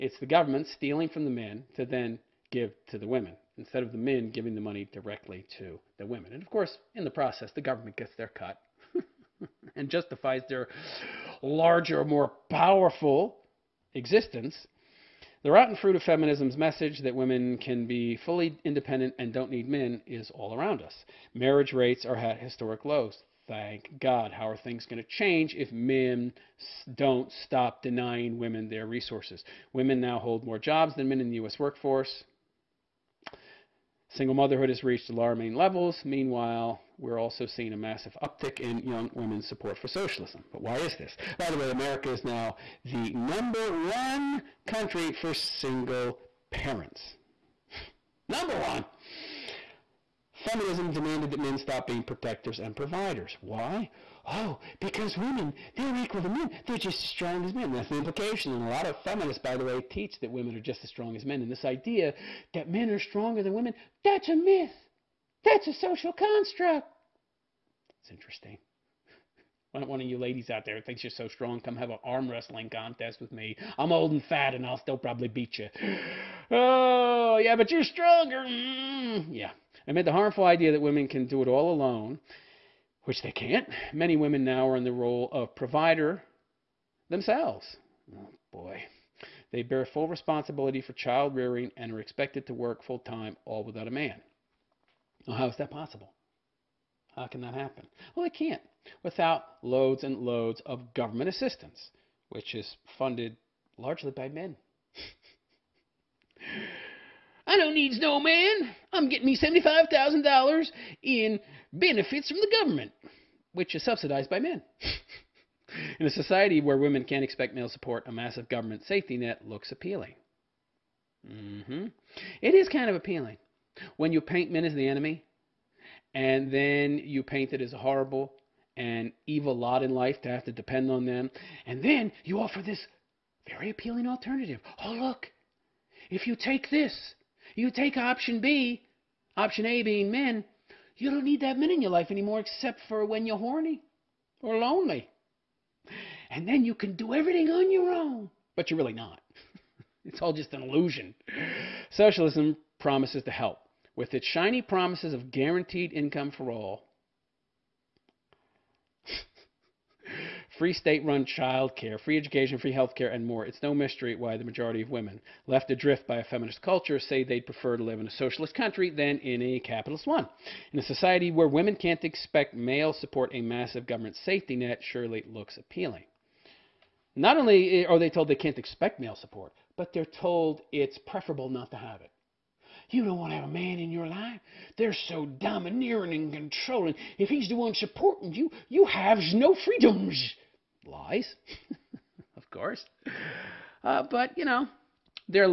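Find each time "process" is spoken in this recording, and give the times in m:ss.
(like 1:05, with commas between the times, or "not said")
0:07.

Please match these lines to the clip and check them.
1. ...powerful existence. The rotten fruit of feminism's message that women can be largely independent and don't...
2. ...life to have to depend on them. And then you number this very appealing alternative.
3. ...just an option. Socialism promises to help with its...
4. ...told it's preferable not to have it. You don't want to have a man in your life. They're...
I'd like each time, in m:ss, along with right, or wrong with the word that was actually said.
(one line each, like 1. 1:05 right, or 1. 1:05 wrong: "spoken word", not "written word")
1. 0:12 wrong: "fully", not "largely"
2. 2:09 wrong: "offer", not "number"
3. 2:30 wrong: "illusion", not "option"
4. 3:00 right.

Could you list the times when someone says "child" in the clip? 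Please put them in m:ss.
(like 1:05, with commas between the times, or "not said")
1:30, 2:41.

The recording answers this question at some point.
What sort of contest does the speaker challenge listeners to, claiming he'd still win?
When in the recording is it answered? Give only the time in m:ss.
1:12.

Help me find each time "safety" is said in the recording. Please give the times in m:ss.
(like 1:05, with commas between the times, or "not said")
1:58, 2:54.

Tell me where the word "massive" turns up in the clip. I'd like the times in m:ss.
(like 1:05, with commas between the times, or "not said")
0:37, 1:58, 2:53.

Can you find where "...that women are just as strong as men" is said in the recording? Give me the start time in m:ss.
1:00.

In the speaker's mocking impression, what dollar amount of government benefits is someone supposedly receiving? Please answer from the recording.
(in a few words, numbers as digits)
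$75,000.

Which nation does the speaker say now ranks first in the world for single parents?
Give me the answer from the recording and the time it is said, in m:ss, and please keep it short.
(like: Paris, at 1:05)
America, at 0:41.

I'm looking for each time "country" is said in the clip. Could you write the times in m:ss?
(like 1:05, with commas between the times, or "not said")
0:44, 2:48.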